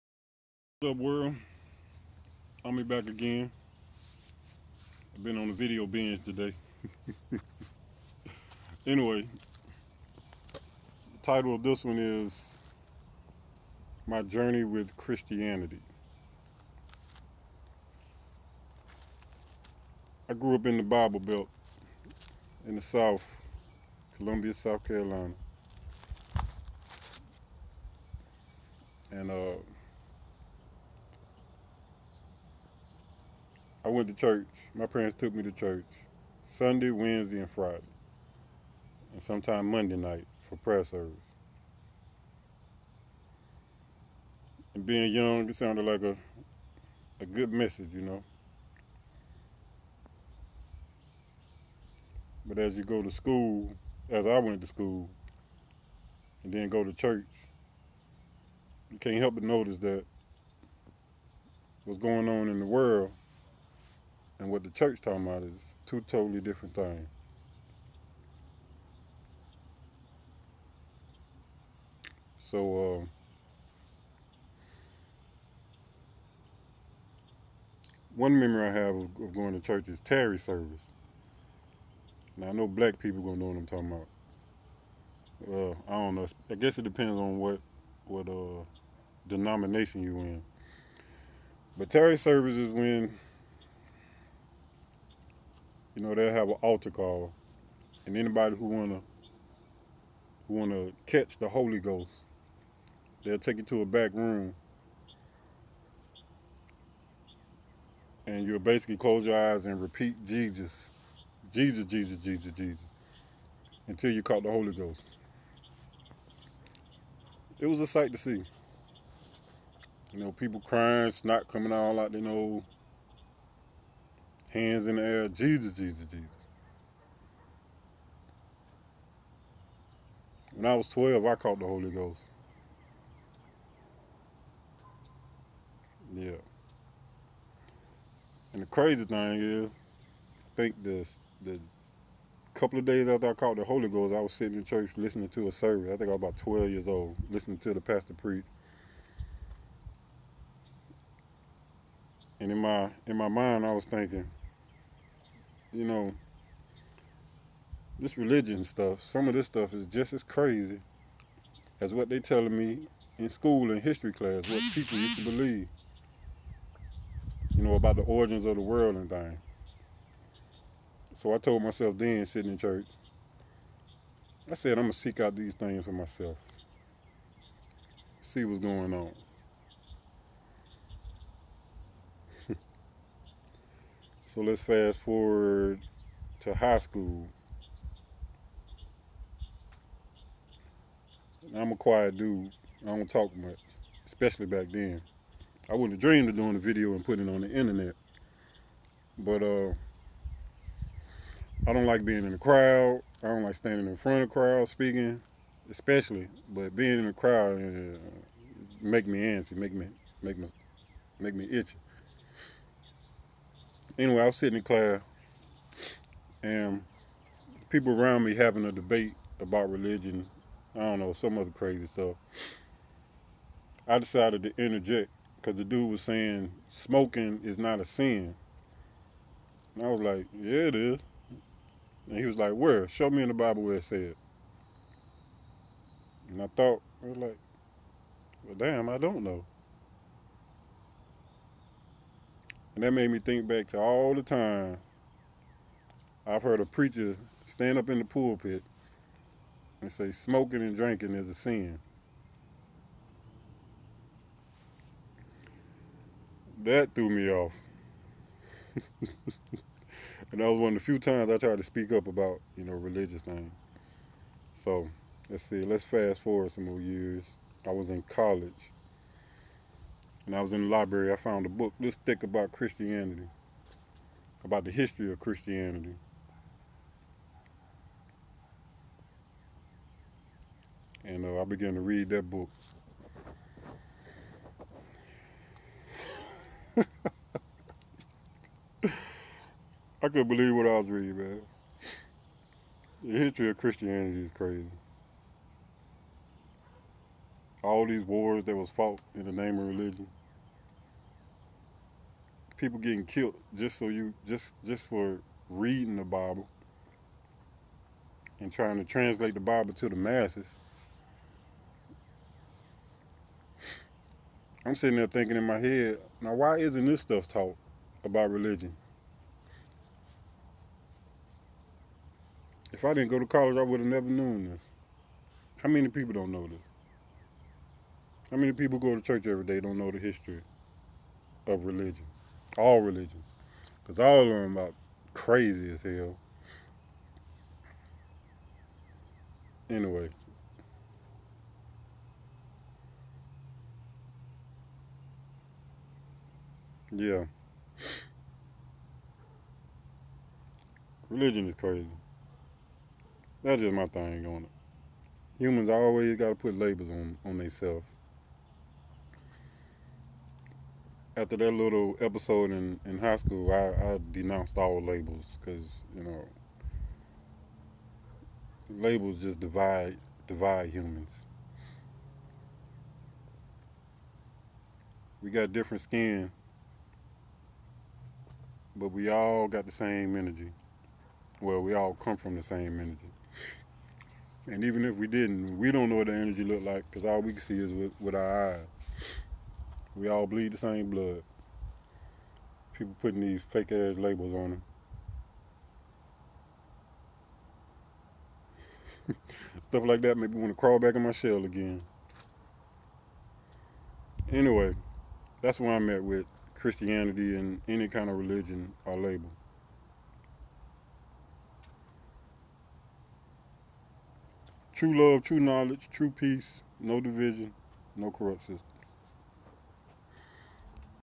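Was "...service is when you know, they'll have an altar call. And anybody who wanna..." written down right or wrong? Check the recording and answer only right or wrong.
right.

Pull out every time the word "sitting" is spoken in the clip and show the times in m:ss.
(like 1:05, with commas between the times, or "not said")
2:24, 2:52, 3:34, 5:14.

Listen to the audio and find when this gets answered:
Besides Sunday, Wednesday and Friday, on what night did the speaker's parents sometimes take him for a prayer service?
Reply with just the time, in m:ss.
0:39.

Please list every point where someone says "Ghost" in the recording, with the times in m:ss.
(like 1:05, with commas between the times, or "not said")
1:41, 1:54, 2:11, 2:23.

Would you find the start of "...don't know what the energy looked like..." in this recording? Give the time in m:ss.
6:25.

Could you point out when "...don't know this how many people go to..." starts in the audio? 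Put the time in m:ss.
5:26.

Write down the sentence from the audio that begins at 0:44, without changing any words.
And being young, it sounded like a a good message, you know.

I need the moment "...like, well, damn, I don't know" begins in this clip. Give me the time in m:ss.
3:57.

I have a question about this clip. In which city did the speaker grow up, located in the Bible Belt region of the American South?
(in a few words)
Columbia, South Carolina.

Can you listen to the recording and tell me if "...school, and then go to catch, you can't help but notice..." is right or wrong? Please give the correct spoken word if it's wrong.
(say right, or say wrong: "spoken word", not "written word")
wrong: "church", not "catch".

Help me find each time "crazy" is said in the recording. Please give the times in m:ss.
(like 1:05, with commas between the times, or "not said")
2:18, 2:40, 3:41, 4:54, 5:35, 5:51.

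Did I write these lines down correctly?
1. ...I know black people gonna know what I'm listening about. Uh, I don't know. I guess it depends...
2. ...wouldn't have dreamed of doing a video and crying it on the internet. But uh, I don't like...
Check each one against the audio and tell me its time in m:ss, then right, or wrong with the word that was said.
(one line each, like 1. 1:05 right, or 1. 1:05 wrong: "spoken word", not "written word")
1. 1:22 wrong: "talking", not "listening"
2. 3:15 wrong: "putting", not "crying".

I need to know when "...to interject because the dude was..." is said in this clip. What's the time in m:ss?
3:44.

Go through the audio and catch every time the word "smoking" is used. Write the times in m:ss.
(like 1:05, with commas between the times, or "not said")
3:46, 4:10.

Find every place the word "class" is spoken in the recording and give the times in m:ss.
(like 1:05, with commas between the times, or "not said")
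2:44, 3:34.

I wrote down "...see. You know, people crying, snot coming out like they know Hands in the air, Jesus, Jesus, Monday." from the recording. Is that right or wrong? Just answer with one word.
wrong.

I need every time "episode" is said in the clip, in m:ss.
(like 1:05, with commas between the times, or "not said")
6:02.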